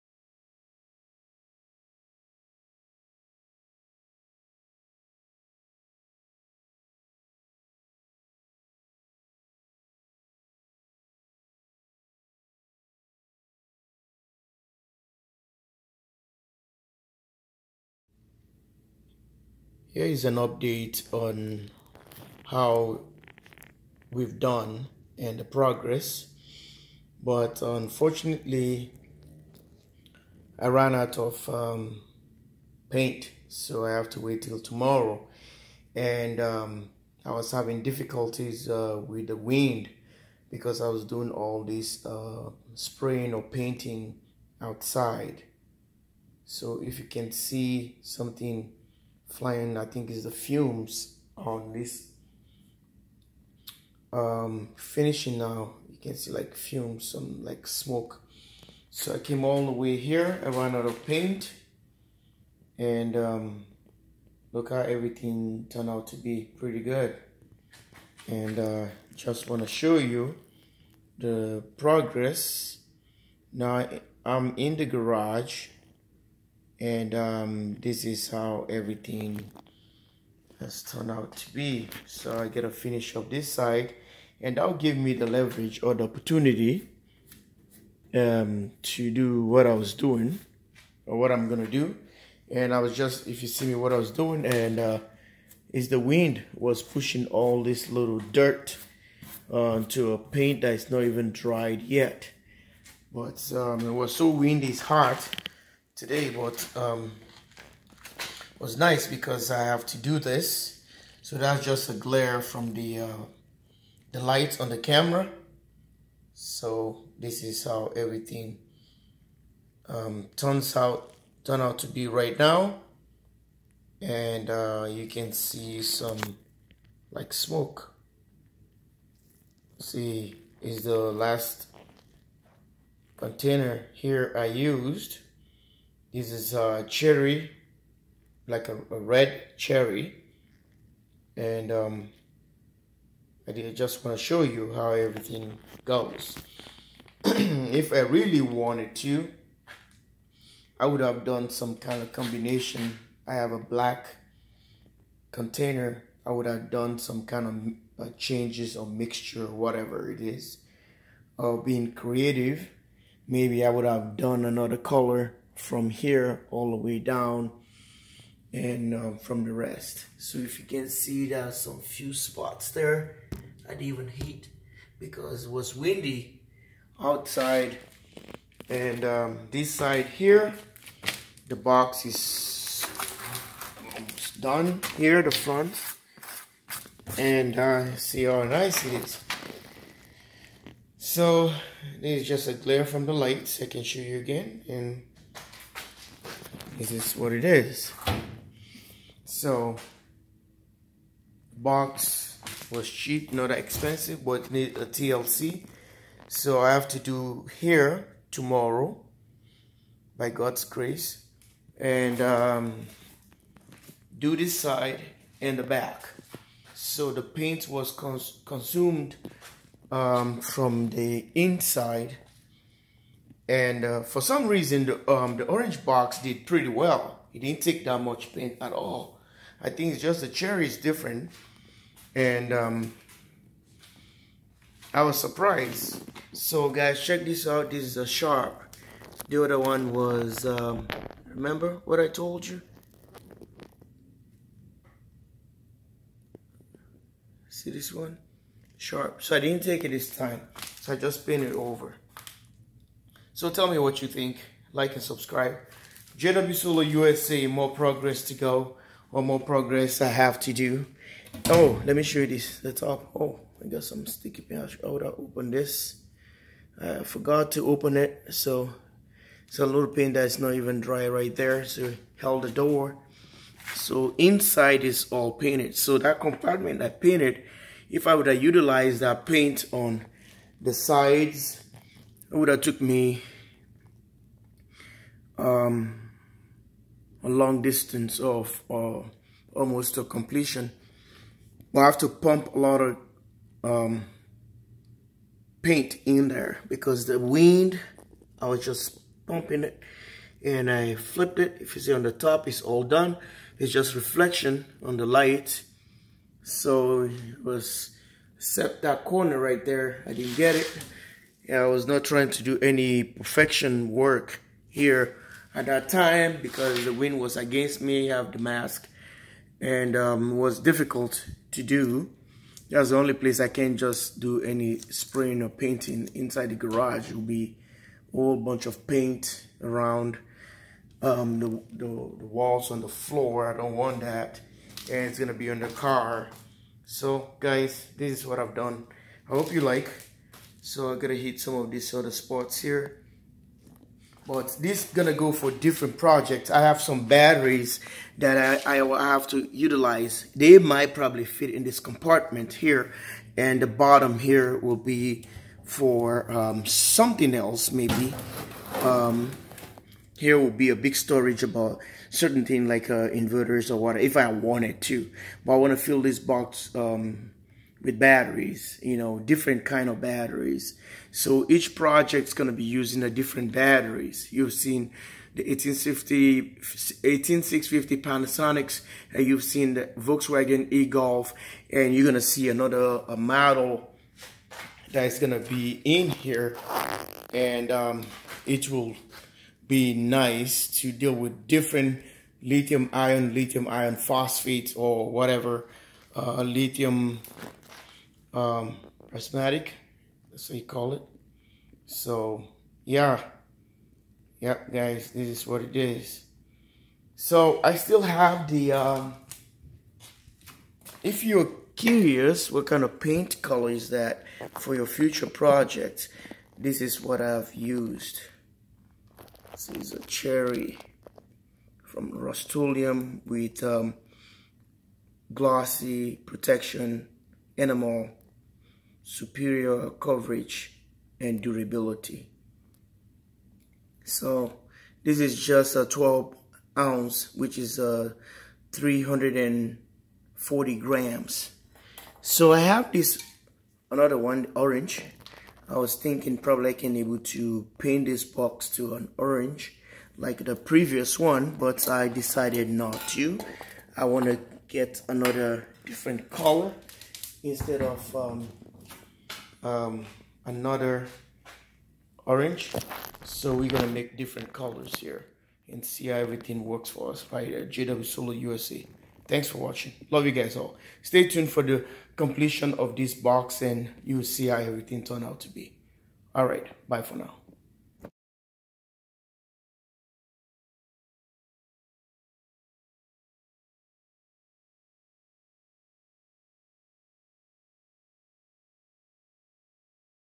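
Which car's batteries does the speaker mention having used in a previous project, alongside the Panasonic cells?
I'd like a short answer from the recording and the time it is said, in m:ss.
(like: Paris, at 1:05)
Volkswagen e-Golf, at 6:19.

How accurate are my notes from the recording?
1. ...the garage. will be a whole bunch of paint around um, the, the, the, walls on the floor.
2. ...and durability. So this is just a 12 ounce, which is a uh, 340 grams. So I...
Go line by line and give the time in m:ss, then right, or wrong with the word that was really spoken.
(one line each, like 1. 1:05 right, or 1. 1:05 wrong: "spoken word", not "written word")
1. 5:26 right
2. 7:11 right.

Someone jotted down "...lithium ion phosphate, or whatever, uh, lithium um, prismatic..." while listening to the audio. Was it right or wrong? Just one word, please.
right.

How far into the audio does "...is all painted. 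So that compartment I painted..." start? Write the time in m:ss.
4:34.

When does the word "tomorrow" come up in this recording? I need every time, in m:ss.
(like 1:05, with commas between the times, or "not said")
0:34, 3:28.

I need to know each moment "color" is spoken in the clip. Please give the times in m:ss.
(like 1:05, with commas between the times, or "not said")
2:44, 6:53, 7:36, 7:44.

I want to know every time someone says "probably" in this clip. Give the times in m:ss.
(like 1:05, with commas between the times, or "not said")
5:50, 7:26.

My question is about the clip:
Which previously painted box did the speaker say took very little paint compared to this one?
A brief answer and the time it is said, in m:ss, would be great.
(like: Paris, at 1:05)
the orange box, at 3:45.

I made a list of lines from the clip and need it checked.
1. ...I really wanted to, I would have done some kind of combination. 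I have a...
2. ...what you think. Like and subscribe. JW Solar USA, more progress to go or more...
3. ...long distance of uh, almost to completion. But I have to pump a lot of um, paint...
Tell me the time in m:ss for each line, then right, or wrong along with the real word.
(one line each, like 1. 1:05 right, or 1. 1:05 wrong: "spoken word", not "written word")
1. 2:27 right
2. 4:13 right
3. 4:47 right.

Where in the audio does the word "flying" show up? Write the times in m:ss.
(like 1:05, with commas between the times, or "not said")
0:49.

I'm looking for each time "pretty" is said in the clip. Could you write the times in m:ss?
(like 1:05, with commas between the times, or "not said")
1:06, 3:46.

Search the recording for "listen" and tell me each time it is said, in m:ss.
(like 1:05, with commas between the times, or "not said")
not said.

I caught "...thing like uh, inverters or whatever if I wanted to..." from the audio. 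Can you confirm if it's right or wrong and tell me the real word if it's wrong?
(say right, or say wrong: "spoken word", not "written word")
right.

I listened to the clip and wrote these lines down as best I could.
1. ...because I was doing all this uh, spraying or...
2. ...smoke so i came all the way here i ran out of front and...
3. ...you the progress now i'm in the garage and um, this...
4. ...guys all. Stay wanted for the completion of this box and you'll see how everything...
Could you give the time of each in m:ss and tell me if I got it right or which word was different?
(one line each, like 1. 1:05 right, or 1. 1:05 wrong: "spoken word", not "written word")
1. 0:40 right
2. 0:57 wrong: "paint", not "front"
3. 1:09 right
4. 7:50 wrong: "tuned", not "wanted".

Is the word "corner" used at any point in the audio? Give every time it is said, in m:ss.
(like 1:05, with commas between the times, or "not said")
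5:09.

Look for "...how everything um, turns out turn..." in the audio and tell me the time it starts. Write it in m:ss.
1:57.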